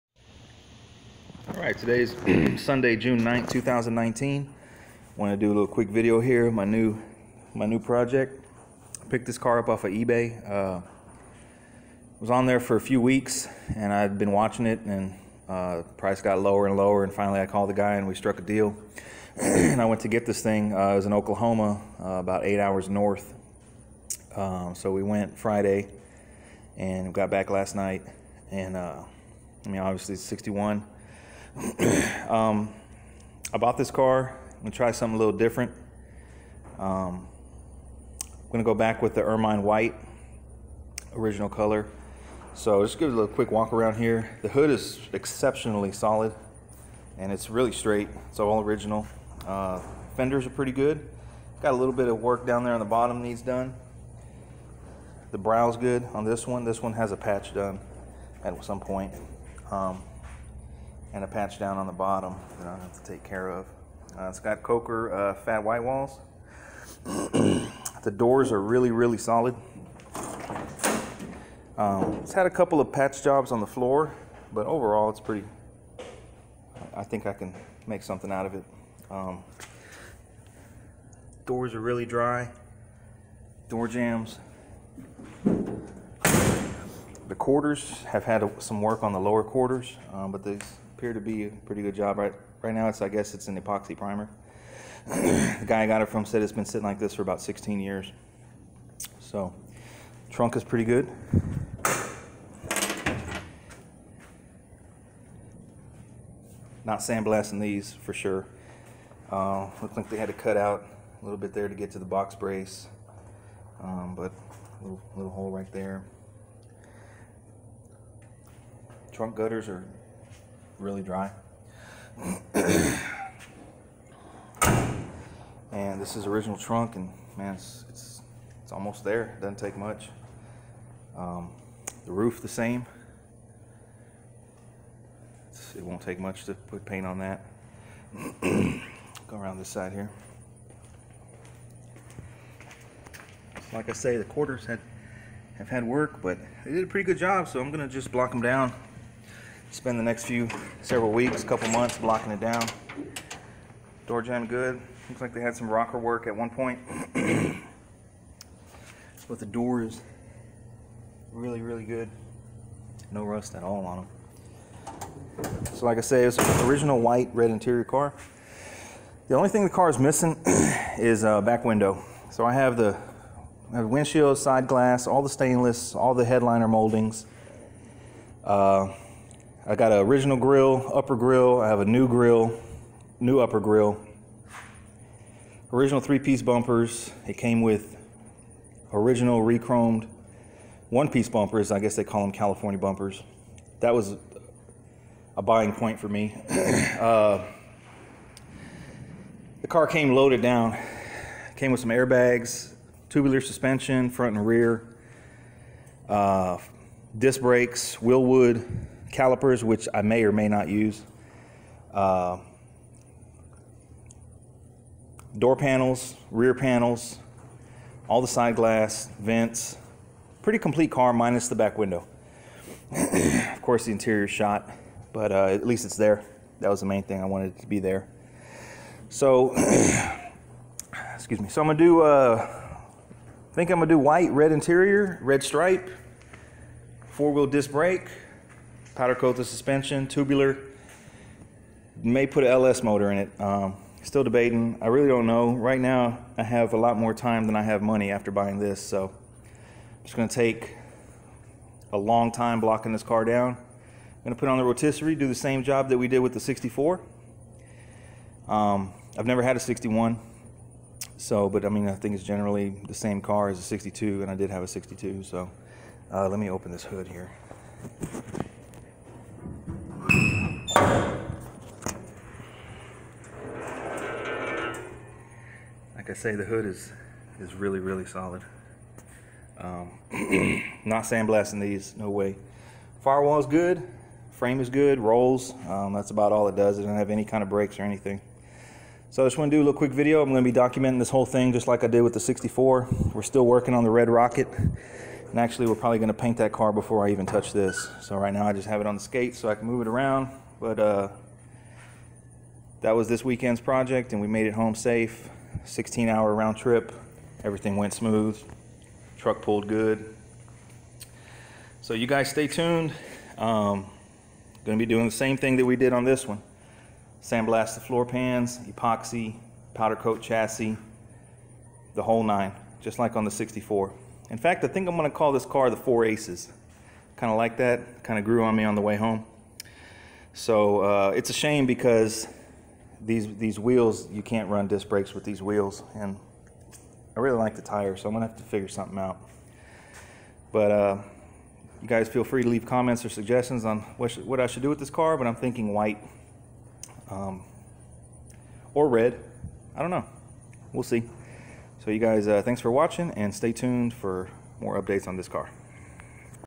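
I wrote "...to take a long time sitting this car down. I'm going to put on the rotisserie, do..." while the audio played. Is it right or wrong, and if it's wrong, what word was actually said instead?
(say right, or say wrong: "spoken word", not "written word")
wrong: "blocking", not "sitting".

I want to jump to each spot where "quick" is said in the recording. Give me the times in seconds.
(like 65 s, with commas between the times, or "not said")
5 s, 43 s, 289 s.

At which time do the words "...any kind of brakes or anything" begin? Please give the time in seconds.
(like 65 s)
287 s.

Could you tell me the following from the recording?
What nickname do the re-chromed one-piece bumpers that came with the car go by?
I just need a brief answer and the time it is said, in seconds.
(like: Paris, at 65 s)
California bumpers, at 192 s.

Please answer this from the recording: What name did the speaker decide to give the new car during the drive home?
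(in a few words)
Four Aces.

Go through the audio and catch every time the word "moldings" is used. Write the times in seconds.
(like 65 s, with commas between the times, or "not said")
176 s.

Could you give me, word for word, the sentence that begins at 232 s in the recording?
Uh, I think I'm gonna do white, red interior, red stripe, four-wheel disc brake powder coat the suspension, tubular.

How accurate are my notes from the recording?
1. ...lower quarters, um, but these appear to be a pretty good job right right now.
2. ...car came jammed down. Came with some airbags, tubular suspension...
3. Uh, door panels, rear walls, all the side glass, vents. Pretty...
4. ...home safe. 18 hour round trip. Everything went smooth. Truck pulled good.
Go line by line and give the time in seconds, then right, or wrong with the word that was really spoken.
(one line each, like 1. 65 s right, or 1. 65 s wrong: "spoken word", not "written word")
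1. 89 s right
2. 199 s wrong: "loaded", not "jammed"
3. 211 s wrong: "panels", not "walls"
4. 304 s wrong: "16", not "18".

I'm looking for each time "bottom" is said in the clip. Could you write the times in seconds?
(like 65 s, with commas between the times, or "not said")
52 s, 61 s.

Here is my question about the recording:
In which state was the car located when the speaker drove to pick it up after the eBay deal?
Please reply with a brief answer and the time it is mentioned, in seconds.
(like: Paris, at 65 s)
Oklahoma, at 21 s.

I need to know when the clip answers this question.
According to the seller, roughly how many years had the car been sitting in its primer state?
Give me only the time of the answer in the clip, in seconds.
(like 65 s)
97 s.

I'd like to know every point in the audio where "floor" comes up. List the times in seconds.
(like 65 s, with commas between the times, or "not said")
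73 s, 317 s.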